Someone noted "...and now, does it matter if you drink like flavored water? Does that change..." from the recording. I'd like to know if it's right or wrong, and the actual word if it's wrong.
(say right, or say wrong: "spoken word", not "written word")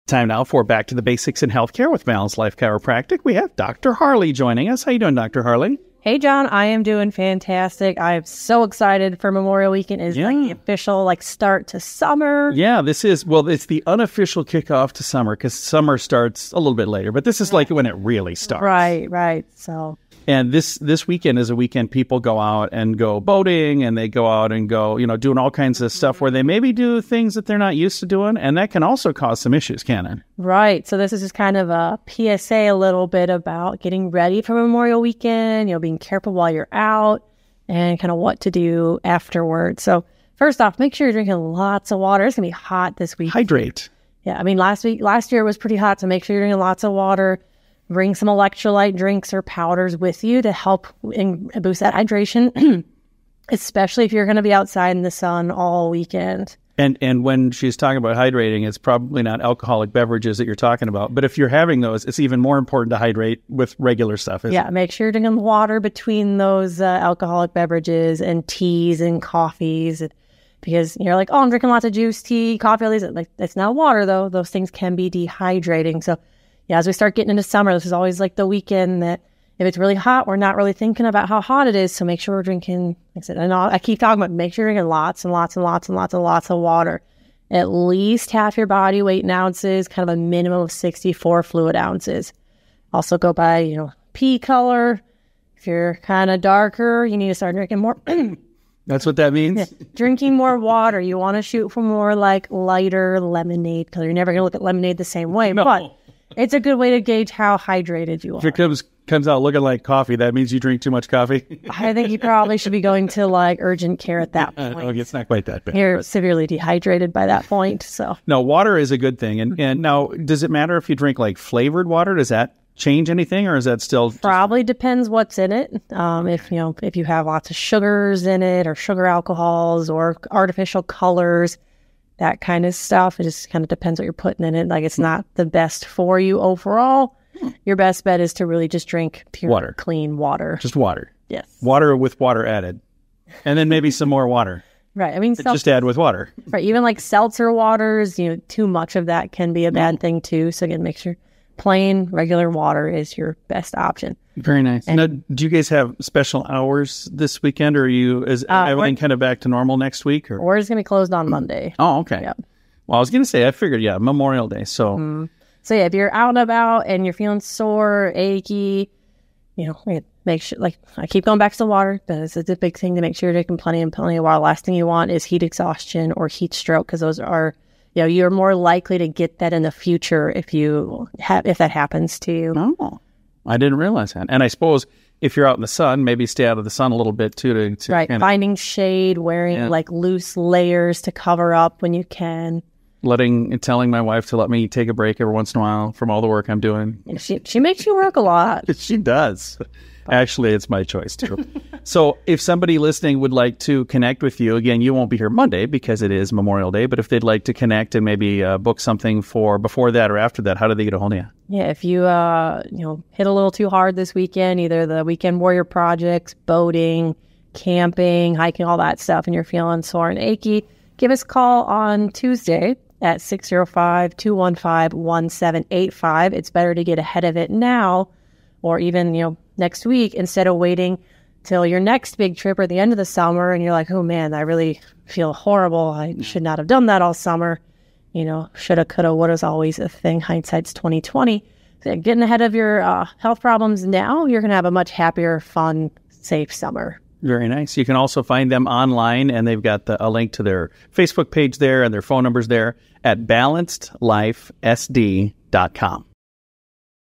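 right.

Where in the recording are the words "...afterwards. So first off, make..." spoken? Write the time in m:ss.
0:39.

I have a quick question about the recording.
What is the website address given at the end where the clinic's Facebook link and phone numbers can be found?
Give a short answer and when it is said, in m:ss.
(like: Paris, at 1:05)
balancedlifesd.com, at 4:13.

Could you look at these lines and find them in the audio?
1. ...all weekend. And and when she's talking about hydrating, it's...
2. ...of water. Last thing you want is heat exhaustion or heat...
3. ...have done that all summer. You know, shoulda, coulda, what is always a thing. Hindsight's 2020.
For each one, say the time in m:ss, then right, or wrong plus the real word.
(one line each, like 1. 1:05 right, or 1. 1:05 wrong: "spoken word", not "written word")
1. 0:55 right
2. 2:54 right
3. 3:56 right.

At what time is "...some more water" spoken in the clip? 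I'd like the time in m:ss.
2:23.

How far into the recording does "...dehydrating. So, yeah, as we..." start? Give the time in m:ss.
1:15.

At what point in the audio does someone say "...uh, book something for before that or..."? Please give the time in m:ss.
3:28.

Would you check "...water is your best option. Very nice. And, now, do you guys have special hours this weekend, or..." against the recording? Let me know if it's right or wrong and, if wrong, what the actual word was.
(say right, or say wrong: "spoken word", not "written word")
right.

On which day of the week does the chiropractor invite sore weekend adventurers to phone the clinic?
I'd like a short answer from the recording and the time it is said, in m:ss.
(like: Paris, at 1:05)
Tuesday, at 3:42.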